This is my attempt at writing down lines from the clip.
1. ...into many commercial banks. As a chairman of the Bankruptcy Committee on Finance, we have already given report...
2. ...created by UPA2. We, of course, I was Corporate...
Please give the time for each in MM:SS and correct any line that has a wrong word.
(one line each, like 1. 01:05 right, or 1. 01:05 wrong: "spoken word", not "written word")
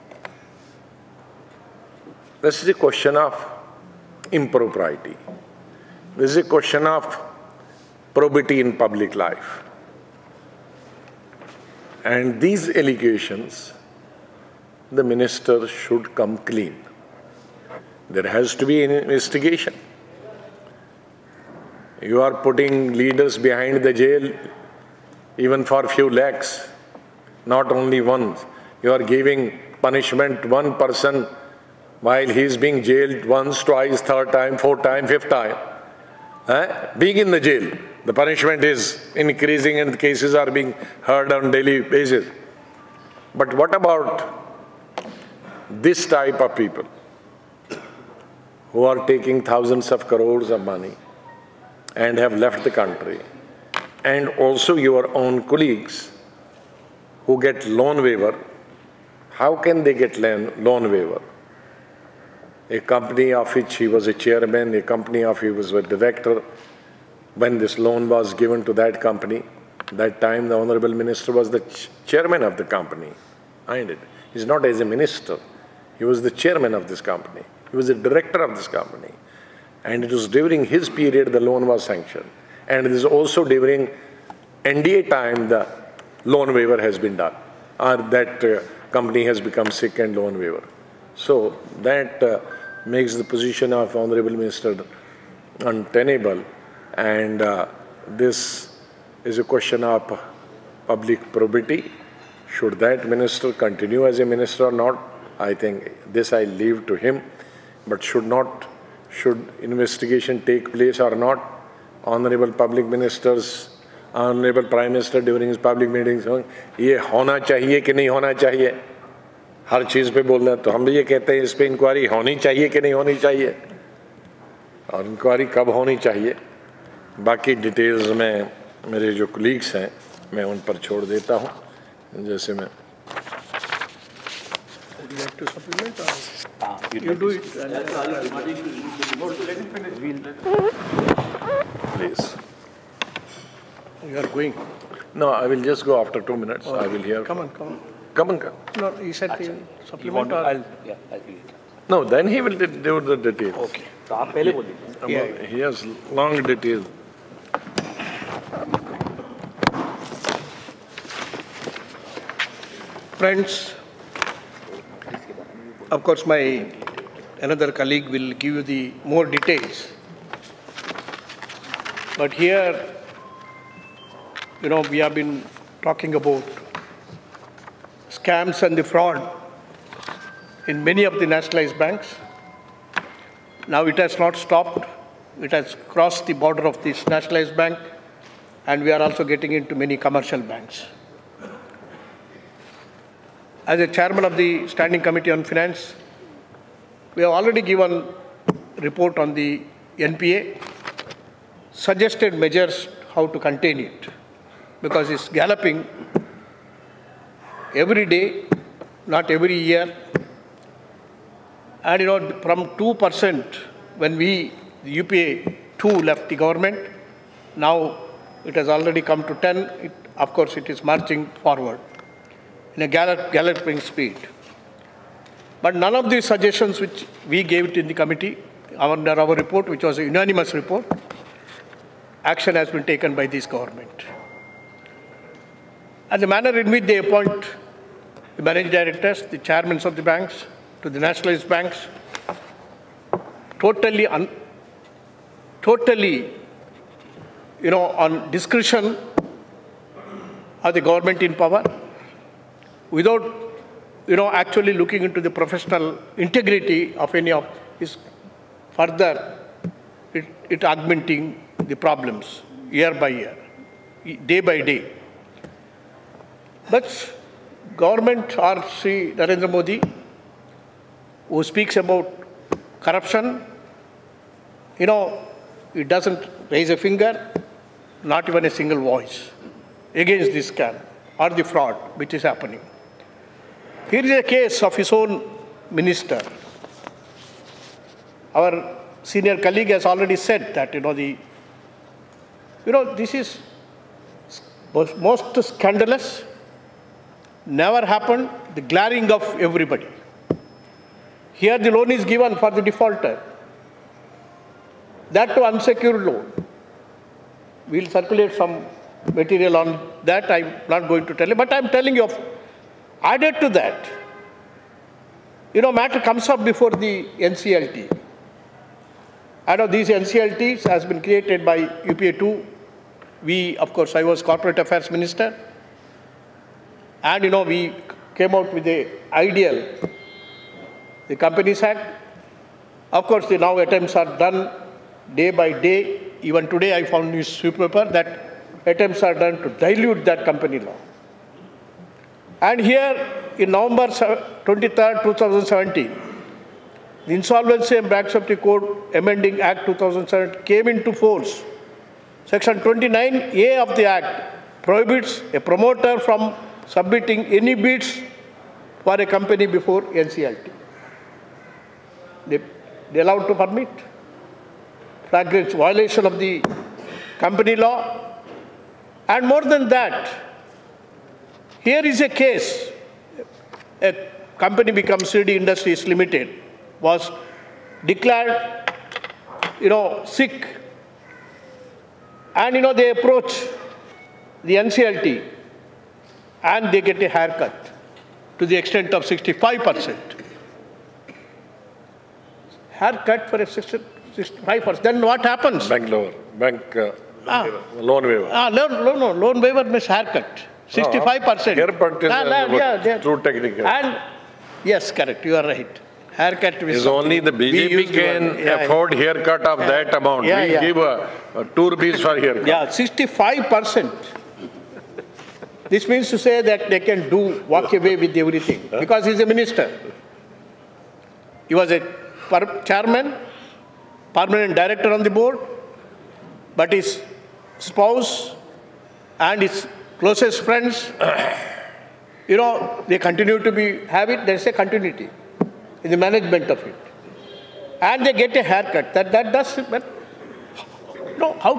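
1. 03:09 wrong: "Standing", not "Bankruptcy"
2. 05:21 right.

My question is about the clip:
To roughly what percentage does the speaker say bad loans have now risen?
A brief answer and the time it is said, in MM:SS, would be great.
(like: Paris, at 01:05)
10, at 03:39.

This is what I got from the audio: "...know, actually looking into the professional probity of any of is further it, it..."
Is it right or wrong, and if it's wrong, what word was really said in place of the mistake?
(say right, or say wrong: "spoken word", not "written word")
wrong: "integrity", not "probity".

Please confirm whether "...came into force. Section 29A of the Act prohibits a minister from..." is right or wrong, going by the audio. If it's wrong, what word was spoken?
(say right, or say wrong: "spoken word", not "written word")
wrong: "promoter", not "minister".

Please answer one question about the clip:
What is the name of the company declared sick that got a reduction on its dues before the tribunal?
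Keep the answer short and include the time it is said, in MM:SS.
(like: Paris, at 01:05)
Shirdi Industries Limited, at 06:15.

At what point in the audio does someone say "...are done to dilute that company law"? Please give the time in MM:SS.
05:39.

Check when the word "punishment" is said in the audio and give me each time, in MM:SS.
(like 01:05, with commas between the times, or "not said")
00:29, 00:38.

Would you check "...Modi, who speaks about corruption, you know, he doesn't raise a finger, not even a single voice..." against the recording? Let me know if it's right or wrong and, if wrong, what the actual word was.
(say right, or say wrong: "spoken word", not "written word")
right.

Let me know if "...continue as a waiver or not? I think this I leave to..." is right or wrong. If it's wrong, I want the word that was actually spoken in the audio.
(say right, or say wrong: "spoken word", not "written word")
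wrong: "minister", not "waiver".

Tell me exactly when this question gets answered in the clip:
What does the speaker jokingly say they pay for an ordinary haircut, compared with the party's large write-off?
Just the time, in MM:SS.
06:51.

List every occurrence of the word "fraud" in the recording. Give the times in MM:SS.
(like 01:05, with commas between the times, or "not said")
02:58, 04:41.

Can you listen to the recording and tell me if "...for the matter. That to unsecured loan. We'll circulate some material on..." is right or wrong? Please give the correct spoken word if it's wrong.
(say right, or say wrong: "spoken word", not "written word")
wrong: "defaulter", not "matter".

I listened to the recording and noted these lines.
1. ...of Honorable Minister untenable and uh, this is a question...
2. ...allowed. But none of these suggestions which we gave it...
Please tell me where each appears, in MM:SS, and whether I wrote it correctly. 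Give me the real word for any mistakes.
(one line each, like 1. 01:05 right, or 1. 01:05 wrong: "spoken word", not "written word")
1. 01:33 right
2. 03:43 wrong: "speed", not "allowed".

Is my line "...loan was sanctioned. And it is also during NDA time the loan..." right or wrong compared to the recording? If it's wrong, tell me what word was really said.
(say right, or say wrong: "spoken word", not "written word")
right.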